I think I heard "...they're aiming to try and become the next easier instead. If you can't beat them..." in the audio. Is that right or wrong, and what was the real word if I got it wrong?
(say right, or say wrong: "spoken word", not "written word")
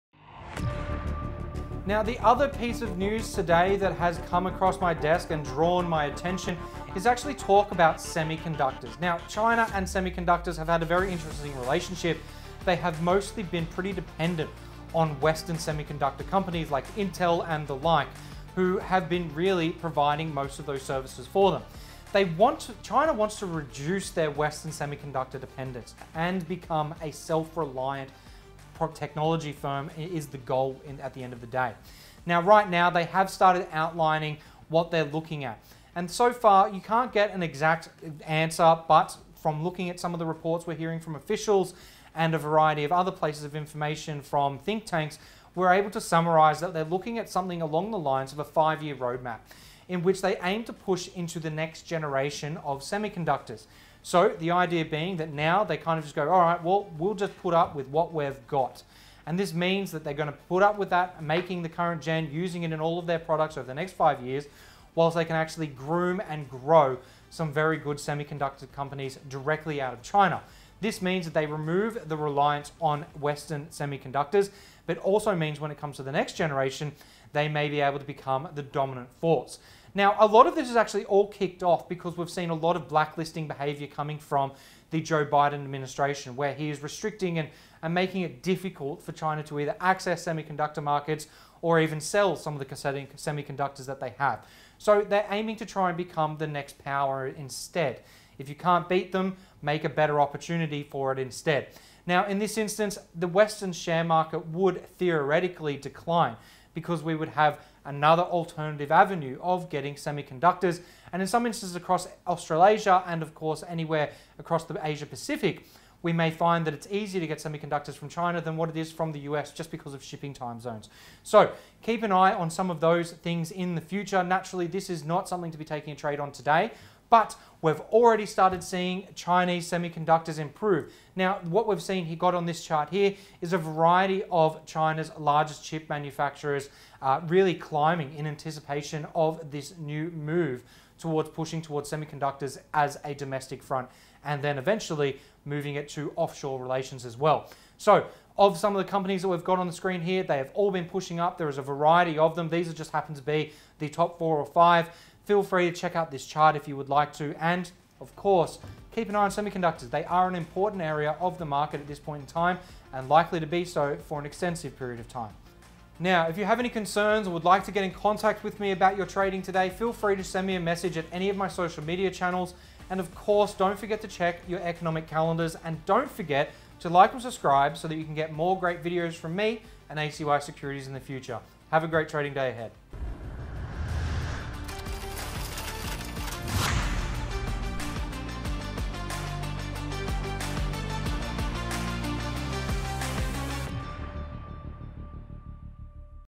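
wrong: "power", not "easier".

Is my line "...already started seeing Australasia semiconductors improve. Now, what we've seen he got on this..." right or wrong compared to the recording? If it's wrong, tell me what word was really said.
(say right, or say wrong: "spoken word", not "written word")
wrong: "Chinese", not "Australasia".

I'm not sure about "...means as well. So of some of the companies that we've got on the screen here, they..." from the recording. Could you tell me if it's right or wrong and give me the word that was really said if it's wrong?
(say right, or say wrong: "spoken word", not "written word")
wrong: "relations", not "means".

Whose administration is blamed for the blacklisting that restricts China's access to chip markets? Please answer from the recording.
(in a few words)
Joe Biden.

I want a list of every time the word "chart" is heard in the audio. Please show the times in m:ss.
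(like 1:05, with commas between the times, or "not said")
2:12, 2:36.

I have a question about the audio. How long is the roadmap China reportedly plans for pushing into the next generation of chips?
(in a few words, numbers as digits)
5 years.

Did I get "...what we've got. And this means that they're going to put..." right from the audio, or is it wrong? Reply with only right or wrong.
right.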